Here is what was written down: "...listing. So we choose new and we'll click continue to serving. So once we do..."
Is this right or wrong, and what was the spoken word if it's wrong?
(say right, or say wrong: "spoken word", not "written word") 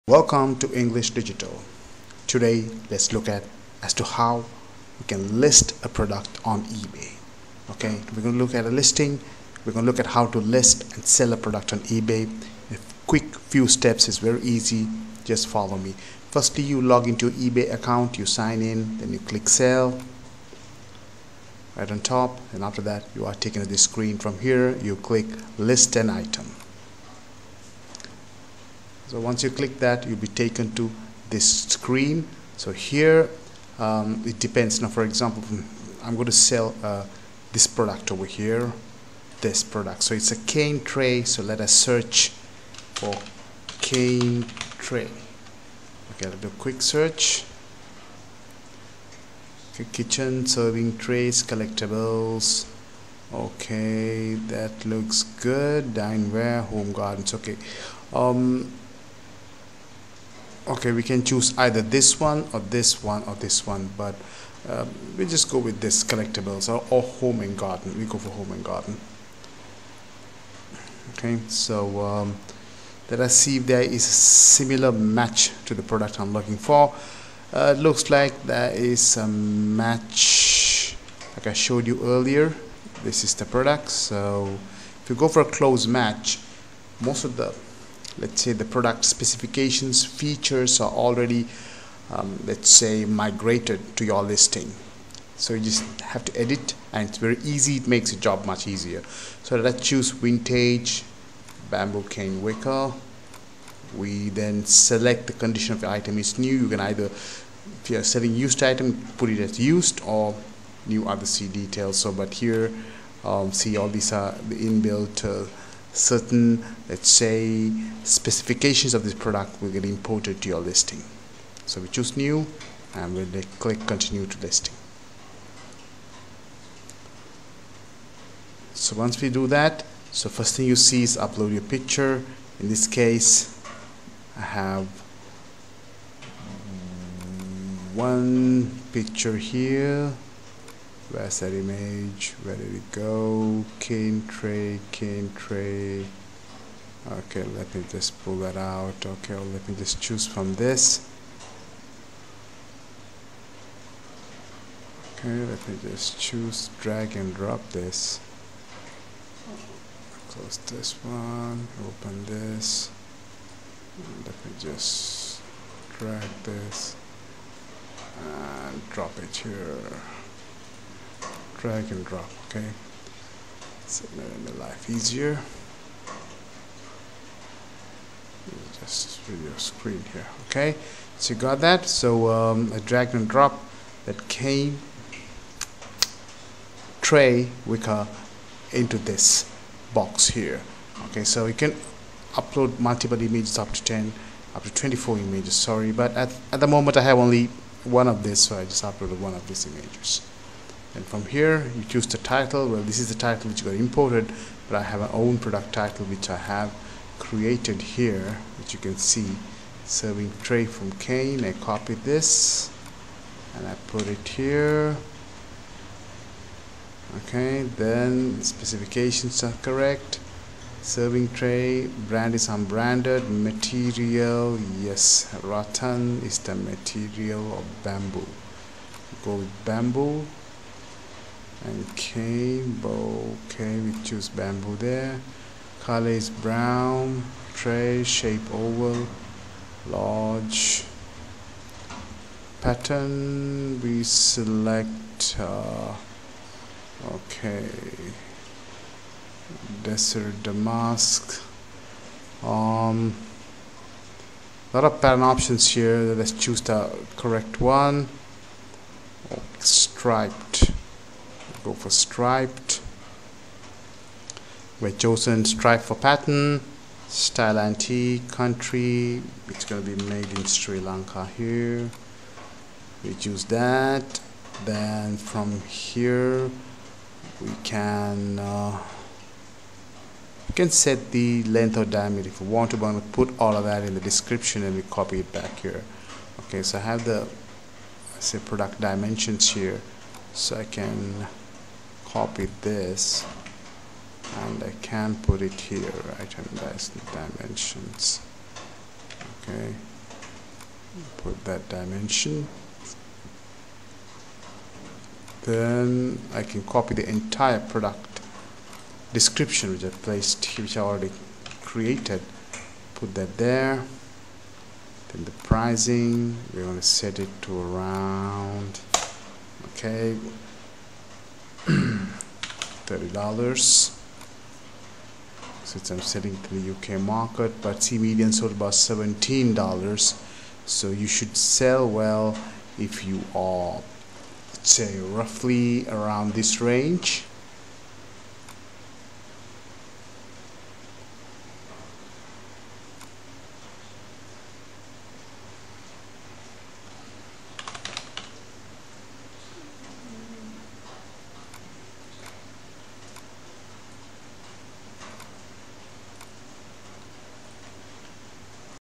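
wrong: "listing", not "serving".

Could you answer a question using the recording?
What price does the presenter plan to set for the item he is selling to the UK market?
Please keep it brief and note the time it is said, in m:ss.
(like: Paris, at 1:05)
$30, at 5:21.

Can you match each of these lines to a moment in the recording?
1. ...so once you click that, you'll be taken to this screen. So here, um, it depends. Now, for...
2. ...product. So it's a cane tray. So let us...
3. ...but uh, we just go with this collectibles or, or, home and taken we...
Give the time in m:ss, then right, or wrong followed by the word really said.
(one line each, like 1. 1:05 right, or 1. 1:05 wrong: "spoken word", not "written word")
1. 0:29 right
2. 0:39 right
3. 1:03 wrong: "garden", not "taken".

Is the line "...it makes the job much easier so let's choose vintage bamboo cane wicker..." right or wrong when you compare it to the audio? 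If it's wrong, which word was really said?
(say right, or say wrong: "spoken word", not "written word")
right.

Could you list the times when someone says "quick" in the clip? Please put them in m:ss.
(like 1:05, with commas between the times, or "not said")
0:13, 0:46.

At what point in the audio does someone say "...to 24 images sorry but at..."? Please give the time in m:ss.
3:14.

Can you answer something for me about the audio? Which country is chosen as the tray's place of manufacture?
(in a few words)
Sri Lanka.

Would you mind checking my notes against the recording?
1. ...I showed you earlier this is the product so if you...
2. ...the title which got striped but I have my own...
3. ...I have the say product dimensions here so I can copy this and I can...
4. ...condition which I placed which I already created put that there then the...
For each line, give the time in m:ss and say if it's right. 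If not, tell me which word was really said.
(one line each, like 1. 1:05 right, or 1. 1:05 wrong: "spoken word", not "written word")
1. 1:21 right
2. 3:23 wrong: "imported", not "striped"
3. 4:46 right
4. 5:09 wrong: "description", not "condition".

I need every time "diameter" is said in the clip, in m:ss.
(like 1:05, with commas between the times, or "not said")
4:41.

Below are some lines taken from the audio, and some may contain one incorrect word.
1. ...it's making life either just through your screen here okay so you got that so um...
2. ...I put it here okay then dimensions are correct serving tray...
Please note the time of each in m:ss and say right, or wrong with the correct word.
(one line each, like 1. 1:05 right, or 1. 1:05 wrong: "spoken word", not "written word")
1. 2:53 wrong: "easier", not "either"
2. 3:33 wrong: "specifications", not "dimensions".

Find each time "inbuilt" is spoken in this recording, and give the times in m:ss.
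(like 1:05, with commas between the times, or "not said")
1:54.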